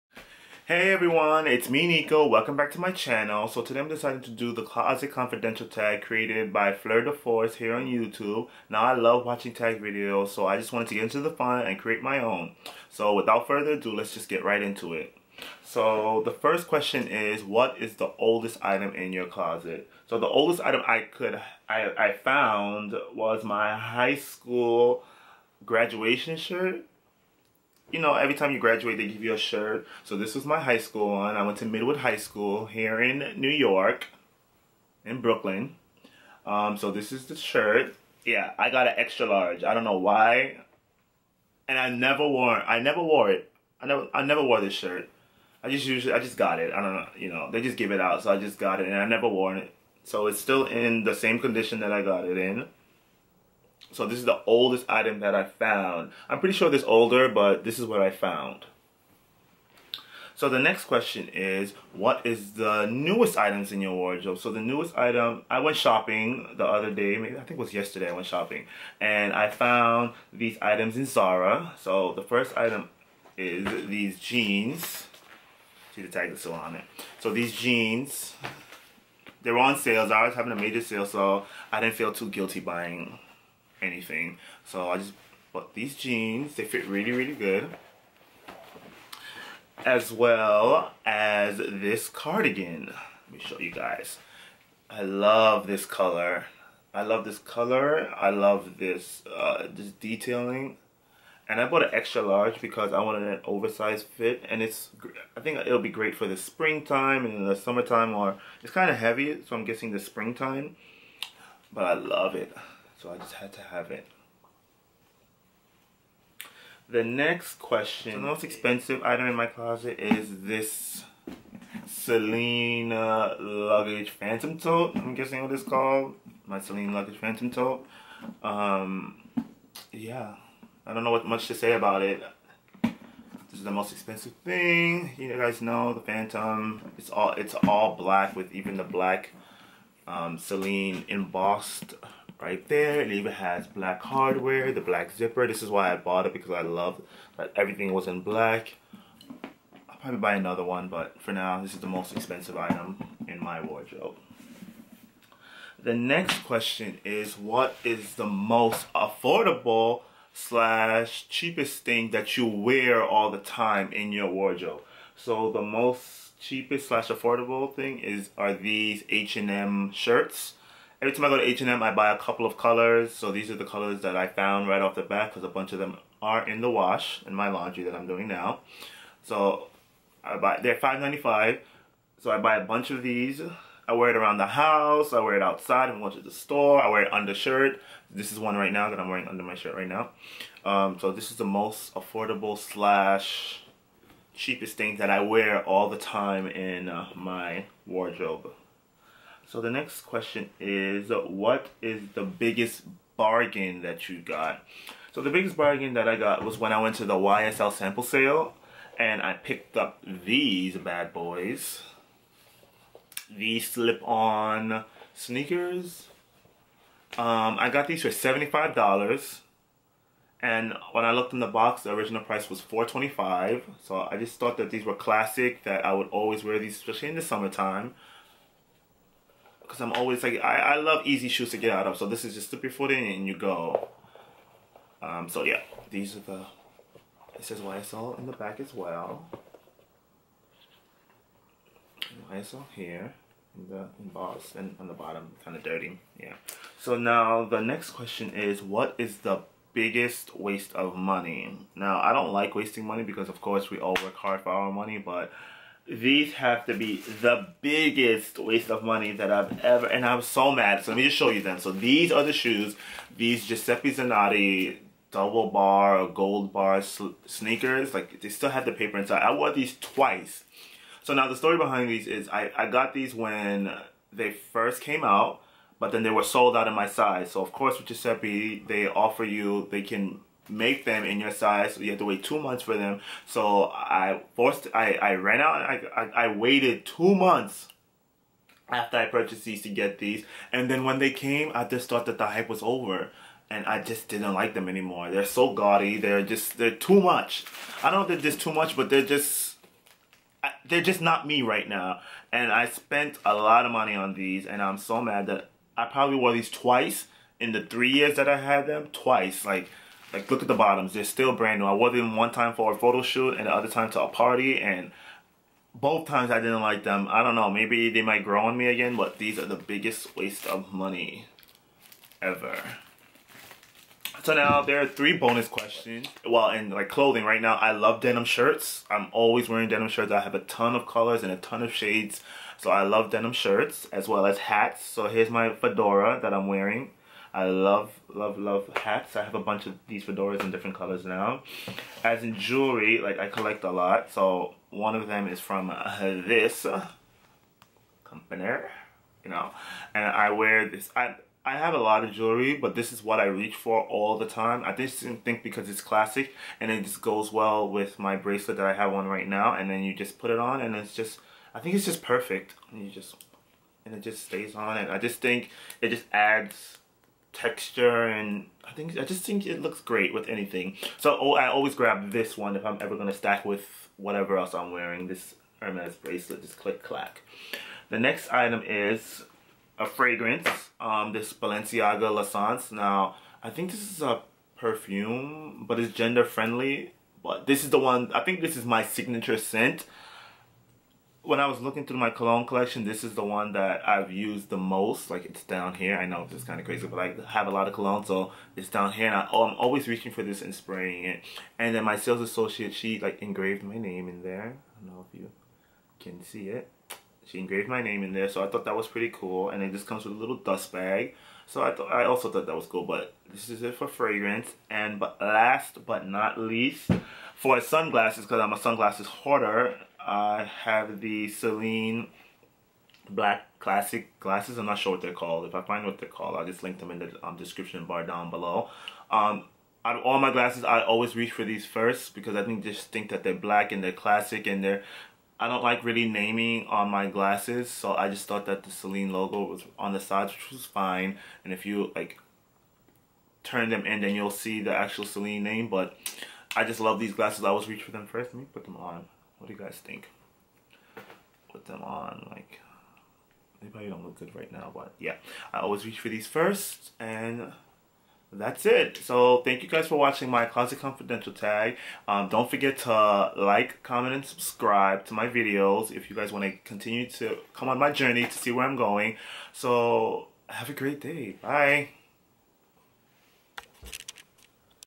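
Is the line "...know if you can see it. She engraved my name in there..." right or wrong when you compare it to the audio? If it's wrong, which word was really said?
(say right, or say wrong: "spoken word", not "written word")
right.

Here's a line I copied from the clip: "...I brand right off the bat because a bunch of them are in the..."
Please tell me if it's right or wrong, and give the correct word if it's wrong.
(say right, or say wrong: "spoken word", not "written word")
wrong: "found", not "brand".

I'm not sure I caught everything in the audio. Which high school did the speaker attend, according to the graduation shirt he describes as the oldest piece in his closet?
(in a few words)
Midwood High School.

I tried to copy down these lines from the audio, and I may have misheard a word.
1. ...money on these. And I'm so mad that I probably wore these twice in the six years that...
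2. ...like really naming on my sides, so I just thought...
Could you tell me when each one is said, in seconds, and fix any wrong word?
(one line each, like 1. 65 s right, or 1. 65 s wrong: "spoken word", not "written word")
1. 303 s wrong: "three", not "six"
2. 435 s wrong: "glasses", not "sides".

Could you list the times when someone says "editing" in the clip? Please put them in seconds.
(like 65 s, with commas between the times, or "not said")
not said.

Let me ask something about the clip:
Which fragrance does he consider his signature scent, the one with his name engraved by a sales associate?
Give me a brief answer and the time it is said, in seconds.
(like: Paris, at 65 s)
Balenciaga L'Essence, at 381 s.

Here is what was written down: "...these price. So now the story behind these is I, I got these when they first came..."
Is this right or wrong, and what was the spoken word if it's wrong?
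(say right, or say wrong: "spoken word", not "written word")
wrong: "twice", not "price".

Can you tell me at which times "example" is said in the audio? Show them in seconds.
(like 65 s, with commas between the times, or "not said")
not said.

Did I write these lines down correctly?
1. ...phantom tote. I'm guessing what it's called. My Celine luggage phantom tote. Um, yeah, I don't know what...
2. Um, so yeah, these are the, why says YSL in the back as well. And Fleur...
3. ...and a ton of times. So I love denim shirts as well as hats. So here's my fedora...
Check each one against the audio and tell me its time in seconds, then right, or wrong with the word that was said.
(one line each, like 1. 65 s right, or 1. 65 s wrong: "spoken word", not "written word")
1. 124 s right
2. 235 s wrong: "YSL", not "Fleur"
3. 331 s wrong: "shades", not "times".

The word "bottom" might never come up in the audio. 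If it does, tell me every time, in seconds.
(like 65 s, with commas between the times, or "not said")
244 s, 310 s.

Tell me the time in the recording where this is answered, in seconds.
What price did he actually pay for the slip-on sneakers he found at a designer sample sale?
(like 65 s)
218 s.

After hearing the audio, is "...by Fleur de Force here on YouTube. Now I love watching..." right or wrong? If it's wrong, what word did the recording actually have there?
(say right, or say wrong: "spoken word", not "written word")
right.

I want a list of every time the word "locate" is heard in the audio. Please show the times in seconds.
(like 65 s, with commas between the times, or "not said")
not said.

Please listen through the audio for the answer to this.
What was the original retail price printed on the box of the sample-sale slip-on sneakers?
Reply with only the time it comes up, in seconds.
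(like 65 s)
222 s.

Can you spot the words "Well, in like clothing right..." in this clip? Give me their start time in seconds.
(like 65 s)
326 s.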